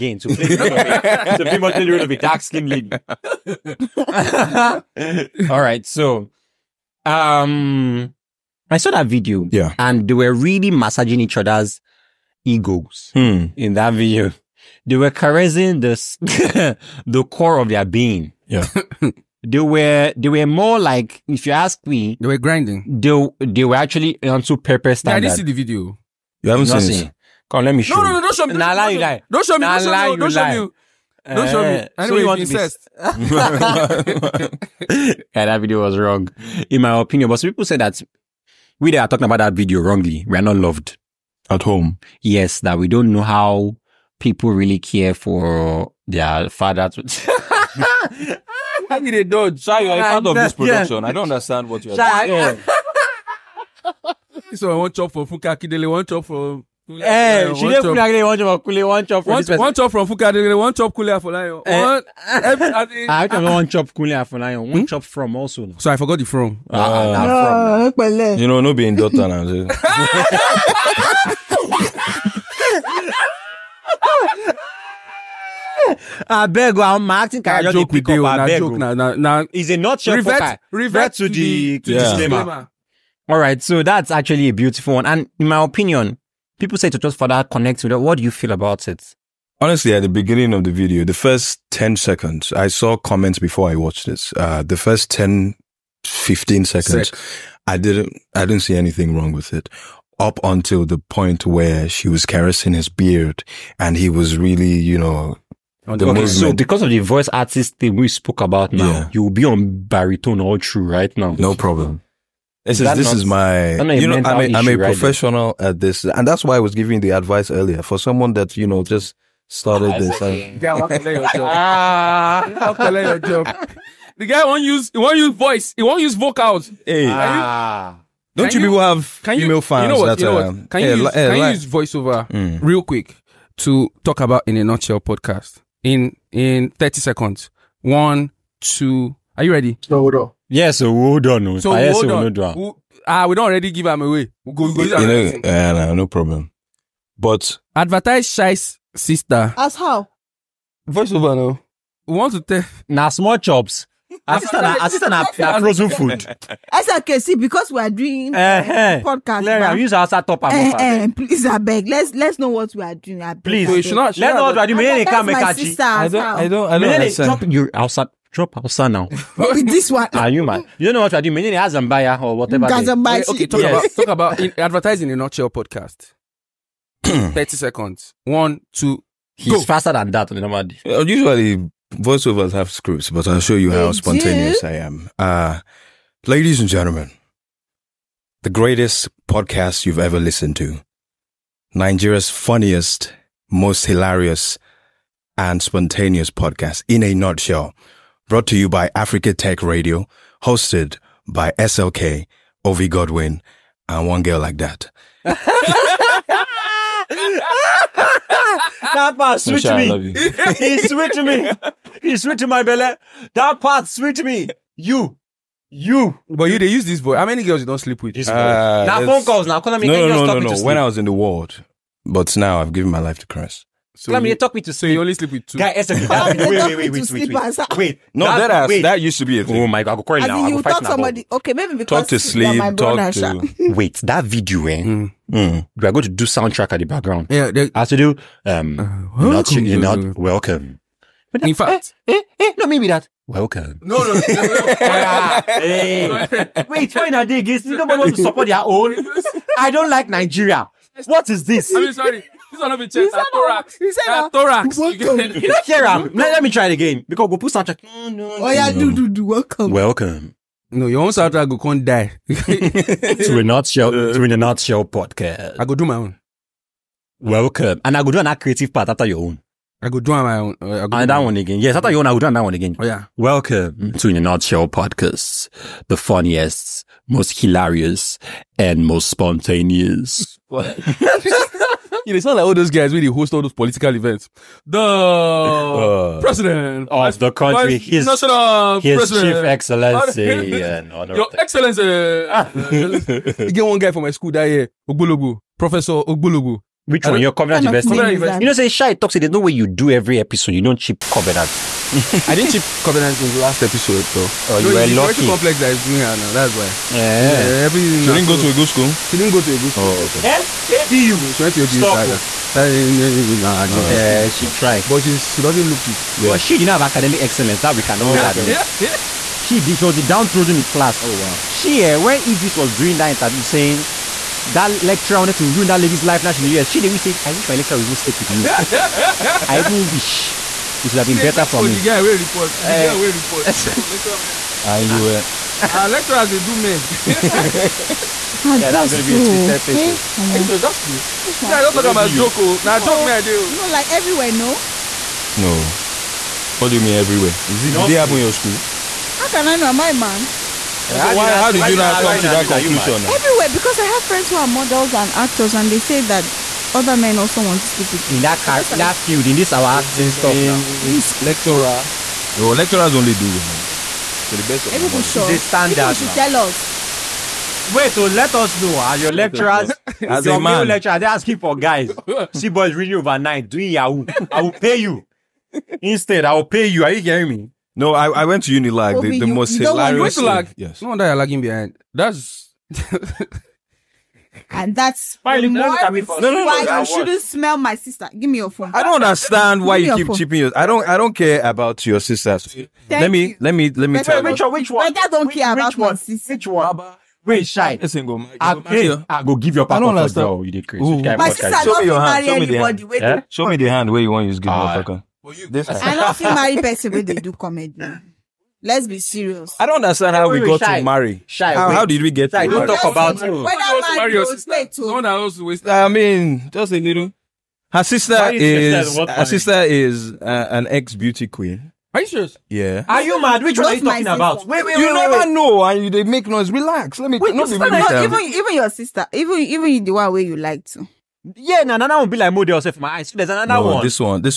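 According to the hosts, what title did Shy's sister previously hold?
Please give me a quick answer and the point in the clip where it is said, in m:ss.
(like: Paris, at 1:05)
Beauty queen, at 7:00.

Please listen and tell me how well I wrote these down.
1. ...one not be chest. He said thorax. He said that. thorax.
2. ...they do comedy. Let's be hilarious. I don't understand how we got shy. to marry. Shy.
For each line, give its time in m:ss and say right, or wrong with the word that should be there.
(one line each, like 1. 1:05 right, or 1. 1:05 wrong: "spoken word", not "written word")
1. 4:12 right
2. 6:47 wrong: "serious", not "hilarious".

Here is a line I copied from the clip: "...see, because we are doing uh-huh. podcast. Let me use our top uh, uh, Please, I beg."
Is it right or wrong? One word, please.
right.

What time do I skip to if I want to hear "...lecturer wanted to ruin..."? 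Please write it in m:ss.
5:24.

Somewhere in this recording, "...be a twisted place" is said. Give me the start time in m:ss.
5:39.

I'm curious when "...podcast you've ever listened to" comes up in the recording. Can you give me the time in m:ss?
3:09.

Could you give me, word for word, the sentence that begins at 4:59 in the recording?
There's no way you do every episode.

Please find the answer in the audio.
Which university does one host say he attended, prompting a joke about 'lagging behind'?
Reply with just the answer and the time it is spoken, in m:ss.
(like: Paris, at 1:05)
Unilag, at 6:18.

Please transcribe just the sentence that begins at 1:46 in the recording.
so because of the voice artist thing we spoke about now, yeah.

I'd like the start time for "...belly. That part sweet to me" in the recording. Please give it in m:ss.
3:32.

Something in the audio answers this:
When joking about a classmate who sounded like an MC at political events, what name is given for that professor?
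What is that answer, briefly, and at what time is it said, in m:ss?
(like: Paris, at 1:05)
Professor Ogbologo, at 4:55.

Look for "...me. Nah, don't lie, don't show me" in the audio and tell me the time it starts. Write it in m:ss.
0:29.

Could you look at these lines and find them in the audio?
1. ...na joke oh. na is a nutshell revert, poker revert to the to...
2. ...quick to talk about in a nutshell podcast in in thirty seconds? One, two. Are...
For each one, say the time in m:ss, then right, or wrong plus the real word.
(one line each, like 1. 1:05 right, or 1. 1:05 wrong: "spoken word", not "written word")
1. 1:18 right
2. 2:12 right.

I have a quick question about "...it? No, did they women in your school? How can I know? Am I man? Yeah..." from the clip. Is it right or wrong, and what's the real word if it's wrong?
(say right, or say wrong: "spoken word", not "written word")
wrong: "happen", not "women".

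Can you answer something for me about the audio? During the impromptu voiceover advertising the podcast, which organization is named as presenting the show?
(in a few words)
Africa Tech Radio.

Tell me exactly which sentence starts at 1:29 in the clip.
Honestly, at the beginning of the video, the first 10 seconds, I saw comments before I watched this.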